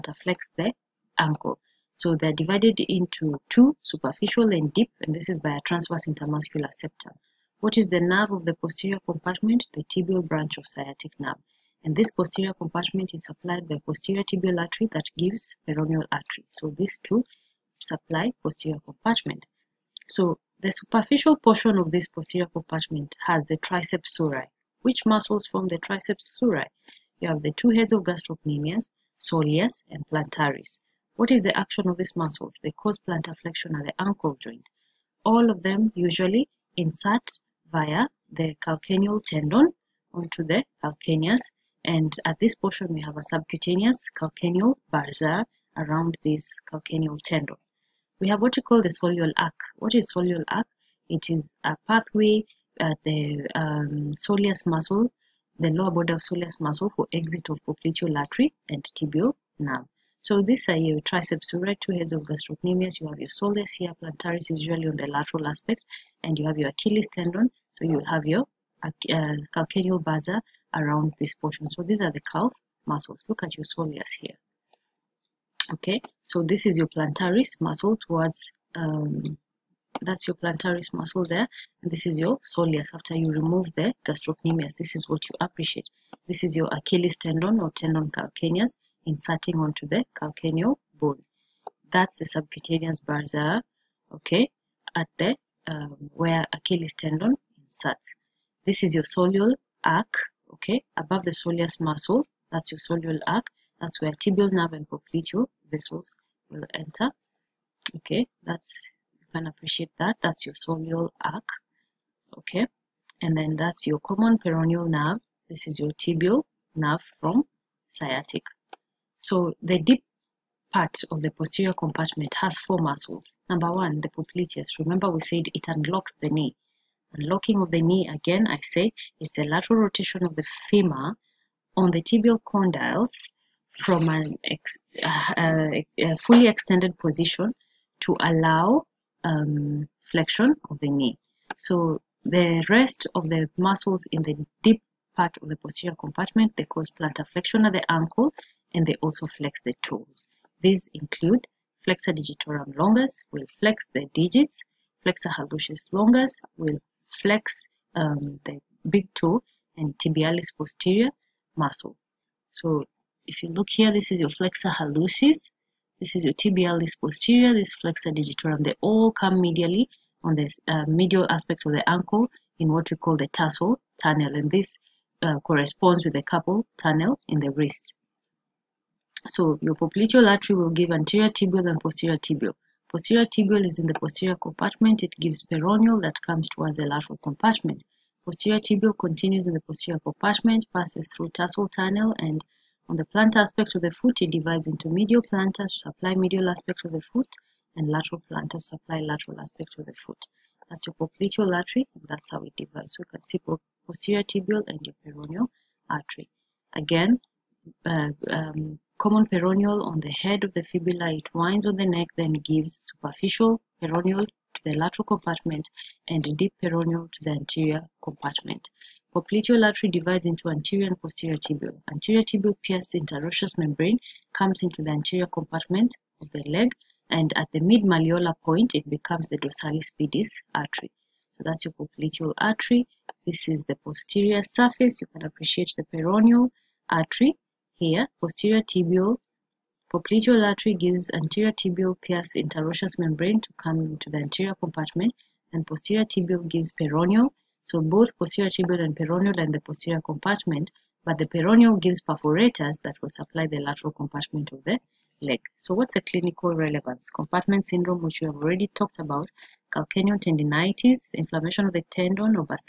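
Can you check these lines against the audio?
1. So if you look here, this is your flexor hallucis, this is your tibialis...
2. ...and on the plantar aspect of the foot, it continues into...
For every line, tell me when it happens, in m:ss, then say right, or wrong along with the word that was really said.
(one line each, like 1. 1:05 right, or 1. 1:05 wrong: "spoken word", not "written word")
1. 2:42 right
2. 3:12 wrong: "divides", not "continues".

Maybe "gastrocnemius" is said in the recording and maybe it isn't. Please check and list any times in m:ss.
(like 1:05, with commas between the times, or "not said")
0:28, 1:02, 1:24.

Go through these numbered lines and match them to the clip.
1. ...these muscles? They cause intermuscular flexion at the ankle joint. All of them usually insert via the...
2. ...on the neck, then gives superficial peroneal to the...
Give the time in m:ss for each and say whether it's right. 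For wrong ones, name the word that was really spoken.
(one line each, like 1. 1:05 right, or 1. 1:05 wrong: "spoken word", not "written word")
1. 0:31 wrong: "plantar", not "intermuscular"
2. 3:31 right.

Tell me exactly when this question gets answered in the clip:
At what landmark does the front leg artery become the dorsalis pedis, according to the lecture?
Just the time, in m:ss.
3:47.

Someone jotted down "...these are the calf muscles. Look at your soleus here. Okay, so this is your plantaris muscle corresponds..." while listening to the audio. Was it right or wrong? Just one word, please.
wrong.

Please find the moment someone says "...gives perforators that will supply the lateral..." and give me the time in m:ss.
4:11.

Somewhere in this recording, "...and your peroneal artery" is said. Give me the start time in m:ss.
3:24.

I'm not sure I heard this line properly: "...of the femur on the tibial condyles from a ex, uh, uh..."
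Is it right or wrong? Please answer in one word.
right.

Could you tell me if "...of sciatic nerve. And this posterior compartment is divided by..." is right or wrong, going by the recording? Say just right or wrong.
wrong.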